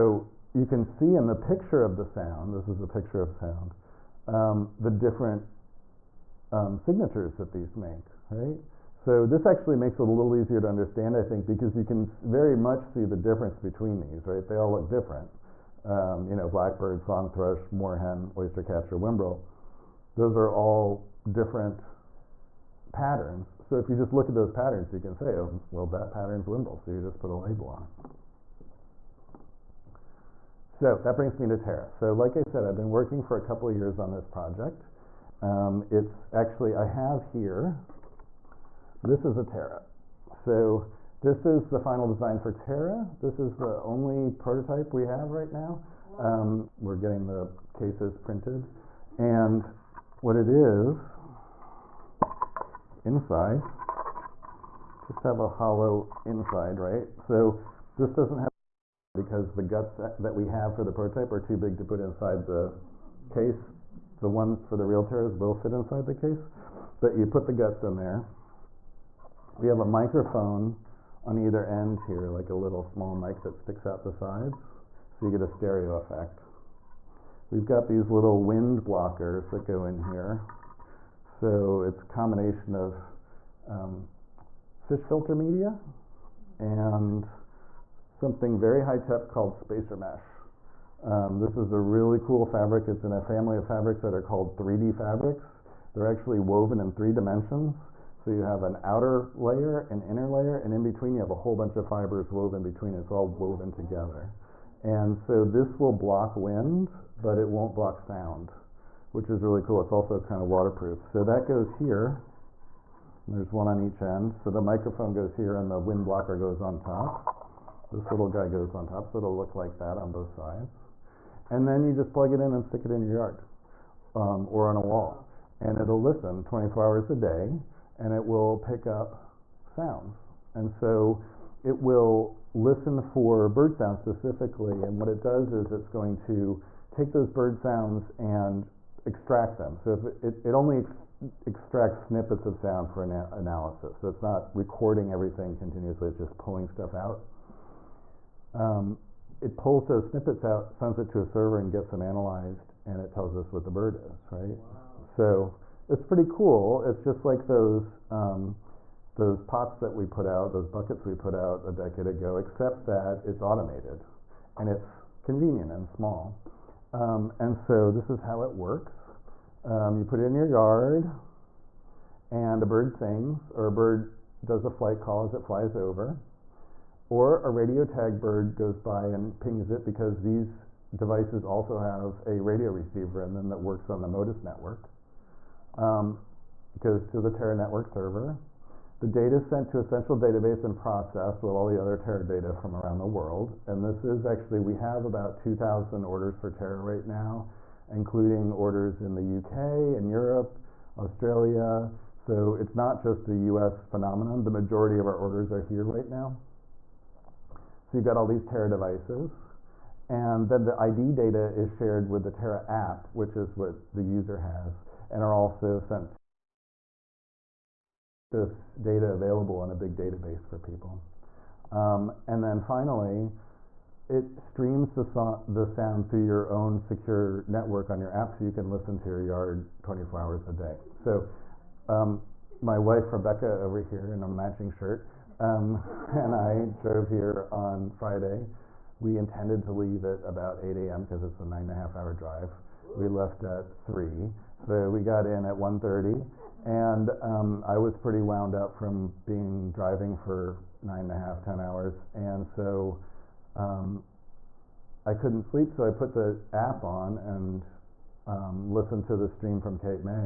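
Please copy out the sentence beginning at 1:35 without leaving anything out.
They're actually woven in three dimensions.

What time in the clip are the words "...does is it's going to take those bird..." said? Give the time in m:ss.
2:15.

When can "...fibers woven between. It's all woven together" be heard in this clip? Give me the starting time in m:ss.
1:41.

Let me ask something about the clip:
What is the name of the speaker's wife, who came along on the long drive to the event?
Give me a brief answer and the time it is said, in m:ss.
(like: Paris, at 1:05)
Rebecca, at 3:53.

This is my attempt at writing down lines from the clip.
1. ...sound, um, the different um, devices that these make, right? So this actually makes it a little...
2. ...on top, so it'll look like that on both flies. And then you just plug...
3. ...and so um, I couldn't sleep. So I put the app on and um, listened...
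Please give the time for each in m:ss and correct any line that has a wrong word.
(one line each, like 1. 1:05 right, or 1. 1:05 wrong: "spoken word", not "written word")
1. 0:03 wrong: "signatures", not "devices"
2. 1:58 wrong: "sides", not "flies"
3. 4:12 right.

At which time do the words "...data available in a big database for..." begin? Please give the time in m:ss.
3:38.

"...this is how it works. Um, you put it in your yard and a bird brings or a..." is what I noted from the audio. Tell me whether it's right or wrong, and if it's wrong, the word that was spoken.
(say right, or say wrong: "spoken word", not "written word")
wrong: "sings", not "brings".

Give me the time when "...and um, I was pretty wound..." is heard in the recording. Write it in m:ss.
4:06.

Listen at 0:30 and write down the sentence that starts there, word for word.
So that brings me to Terra.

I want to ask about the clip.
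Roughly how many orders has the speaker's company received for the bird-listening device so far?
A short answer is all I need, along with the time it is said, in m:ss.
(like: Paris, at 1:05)
2,000, at 3:15.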